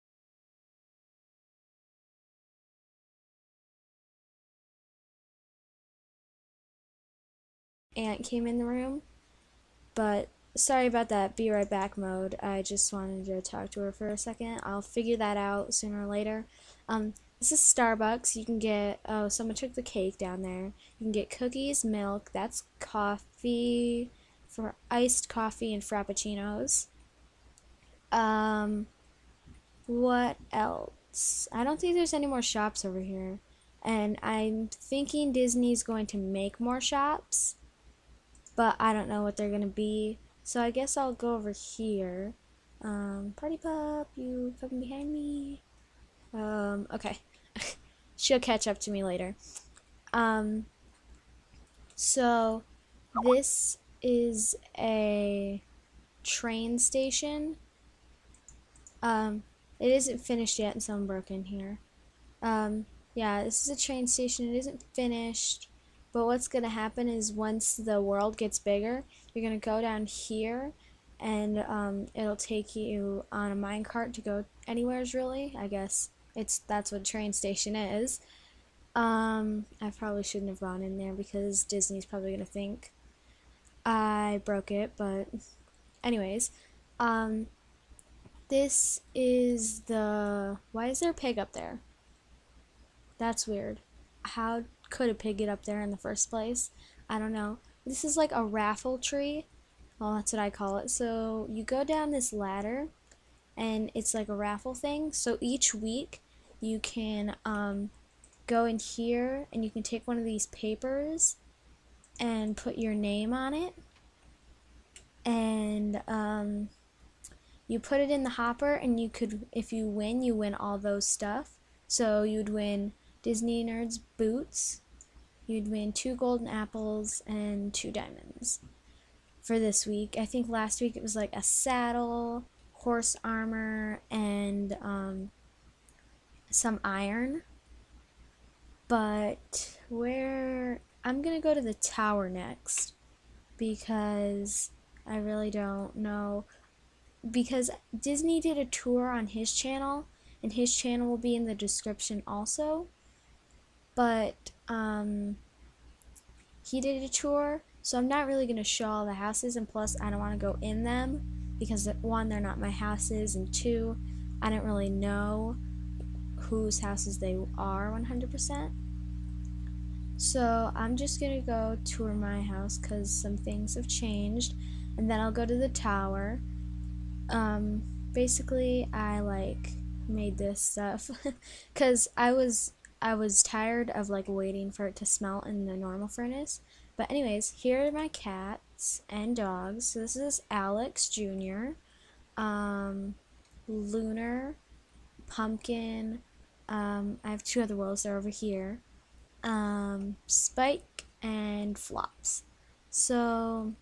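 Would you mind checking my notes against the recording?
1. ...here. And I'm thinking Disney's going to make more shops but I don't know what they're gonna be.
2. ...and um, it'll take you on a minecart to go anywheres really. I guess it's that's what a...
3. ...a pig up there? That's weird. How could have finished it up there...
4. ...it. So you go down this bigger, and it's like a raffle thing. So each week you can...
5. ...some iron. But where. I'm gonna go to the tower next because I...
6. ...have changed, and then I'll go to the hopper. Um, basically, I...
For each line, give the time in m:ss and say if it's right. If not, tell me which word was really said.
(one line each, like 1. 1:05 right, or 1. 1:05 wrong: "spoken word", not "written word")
1. 0:32 right
2. 1:11 right
3. 1:31 wrong: "picked", not "finished"
4. 1:40 wrong: "ladder", not "bigger"
5. 2:16 right
6. 2:53 wrong: "tower", not "hopper".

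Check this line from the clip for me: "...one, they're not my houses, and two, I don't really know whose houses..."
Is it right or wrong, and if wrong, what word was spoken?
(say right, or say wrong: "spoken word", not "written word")
right.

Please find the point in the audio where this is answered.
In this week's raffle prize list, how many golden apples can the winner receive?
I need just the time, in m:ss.
2:05.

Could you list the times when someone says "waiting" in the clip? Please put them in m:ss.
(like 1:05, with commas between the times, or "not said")
3:04.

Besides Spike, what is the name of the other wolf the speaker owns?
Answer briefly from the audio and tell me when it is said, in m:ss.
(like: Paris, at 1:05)
Flops, at 3:21.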